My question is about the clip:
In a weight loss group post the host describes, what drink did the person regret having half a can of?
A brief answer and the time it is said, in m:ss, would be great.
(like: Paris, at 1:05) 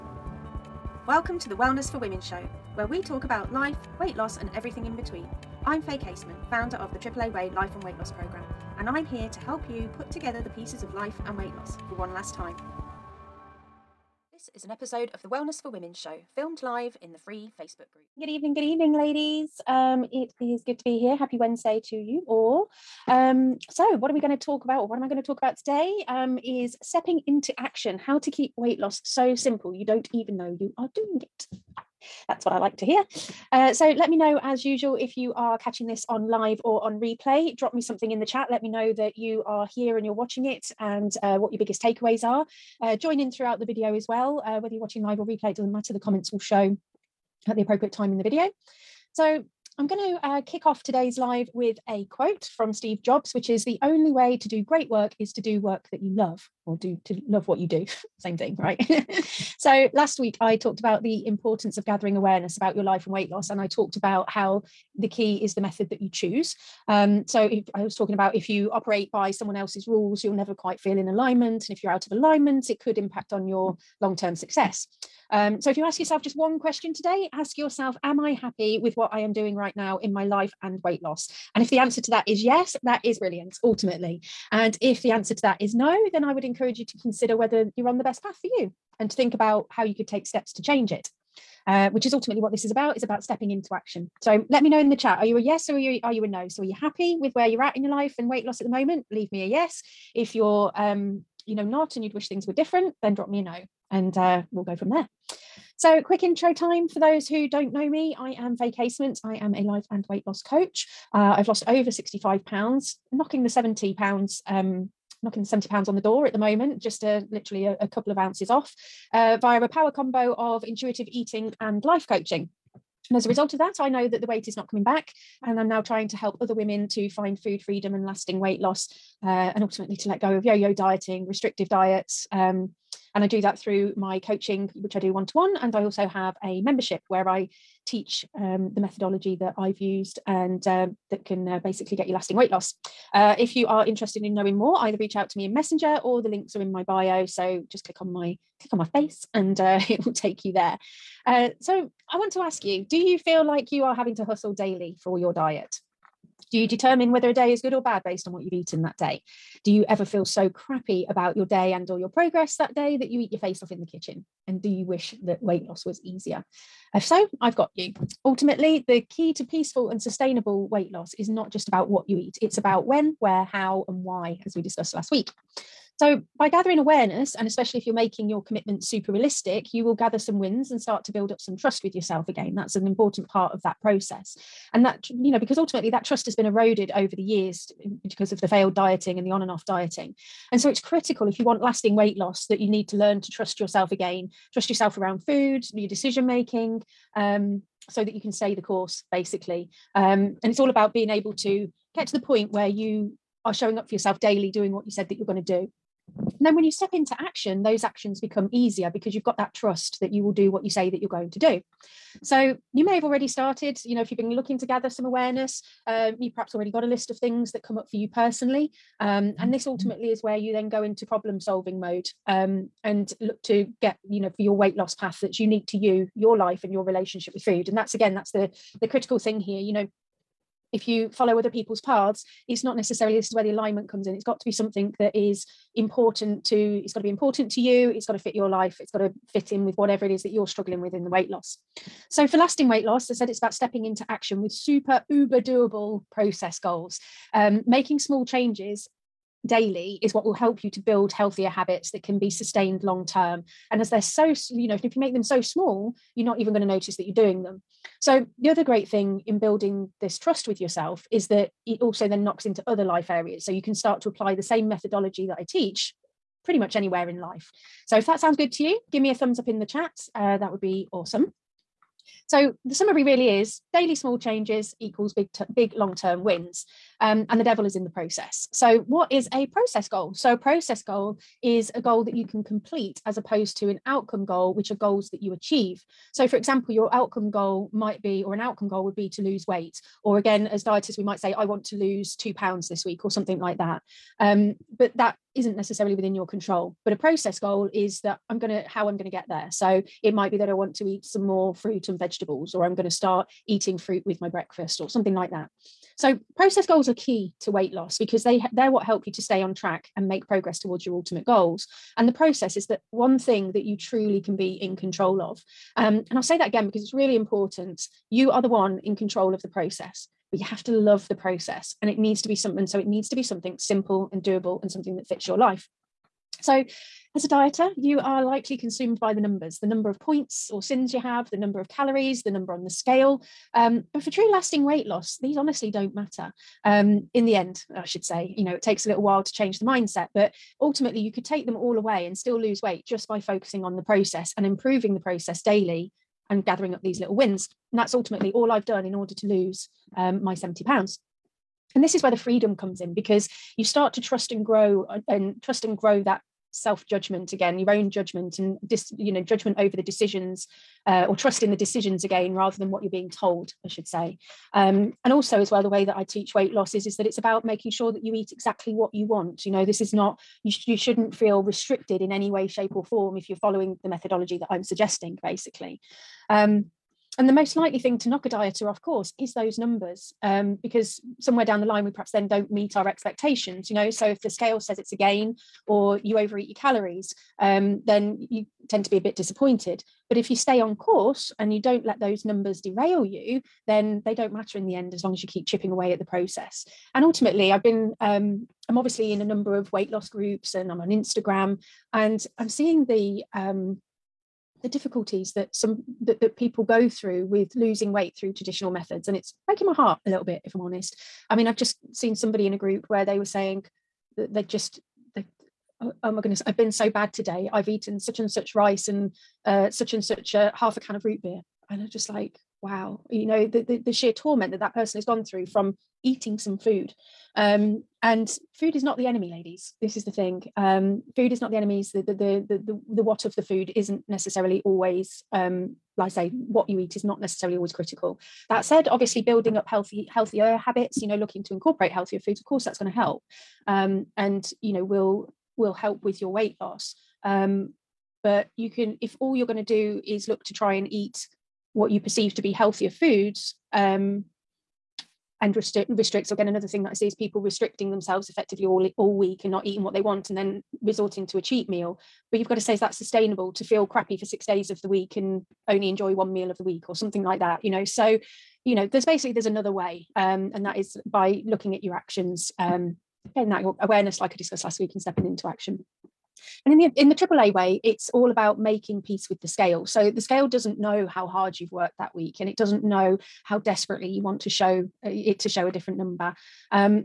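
root beer, at 7:01.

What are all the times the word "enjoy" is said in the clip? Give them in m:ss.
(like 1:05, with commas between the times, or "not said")
7:45.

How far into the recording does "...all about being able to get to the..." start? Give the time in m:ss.
3:20.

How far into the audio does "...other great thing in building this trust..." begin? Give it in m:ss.
4:18.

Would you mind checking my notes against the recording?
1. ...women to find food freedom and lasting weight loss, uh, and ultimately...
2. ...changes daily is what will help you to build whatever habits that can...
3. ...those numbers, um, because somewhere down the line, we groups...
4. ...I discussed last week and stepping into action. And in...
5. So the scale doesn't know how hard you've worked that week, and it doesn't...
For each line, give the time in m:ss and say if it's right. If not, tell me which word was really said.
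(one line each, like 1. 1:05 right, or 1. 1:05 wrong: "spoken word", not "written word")
1. 2:06 right
2. 4:08 wrong: "healthier", not "whatever"
3. 6:19 wrong: "perhaps", not "groups"
4. 7:54 right
5. 7:59 right.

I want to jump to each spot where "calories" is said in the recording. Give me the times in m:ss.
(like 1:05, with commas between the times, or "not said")
5:31, 6:26.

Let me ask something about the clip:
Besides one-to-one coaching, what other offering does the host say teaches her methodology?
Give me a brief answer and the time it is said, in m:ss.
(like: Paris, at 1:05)
a membership, at 2:16.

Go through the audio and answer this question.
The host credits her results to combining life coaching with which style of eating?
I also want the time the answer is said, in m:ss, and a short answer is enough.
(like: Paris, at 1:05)
intuitive eating, at 2:00.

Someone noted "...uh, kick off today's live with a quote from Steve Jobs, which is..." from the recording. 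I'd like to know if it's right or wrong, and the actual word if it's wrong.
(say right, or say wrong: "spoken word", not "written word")
right.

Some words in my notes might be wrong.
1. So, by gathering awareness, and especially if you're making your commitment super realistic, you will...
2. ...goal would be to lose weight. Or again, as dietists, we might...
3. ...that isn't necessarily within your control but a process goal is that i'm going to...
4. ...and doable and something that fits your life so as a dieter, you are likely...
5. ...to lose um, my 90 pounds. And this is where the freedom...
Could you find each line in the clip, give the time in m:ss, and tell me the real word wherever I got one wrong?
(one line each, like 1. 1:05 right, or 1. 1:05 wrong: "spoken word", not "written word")
1. 2:55 right
2. 4:48 right
3. 4:54 right
4. 5:24 right
5. 5:49 wrong: "70", not "90".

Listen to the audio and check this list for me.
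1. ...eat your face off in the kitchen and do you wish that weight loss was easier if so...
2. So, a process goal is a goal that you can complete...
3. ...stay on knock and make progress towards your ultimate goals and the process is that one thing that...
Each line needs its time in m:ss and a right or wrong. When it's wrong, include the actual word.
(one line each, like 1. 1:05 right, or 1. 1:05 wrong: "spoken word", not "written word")
1. 2:43 right
2. 4:40 right
3. 5:09 wrong: "track", not "knock".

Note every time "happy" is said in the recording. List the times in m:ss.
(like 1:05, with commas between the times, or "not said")
0:21, 1:18, 1:36.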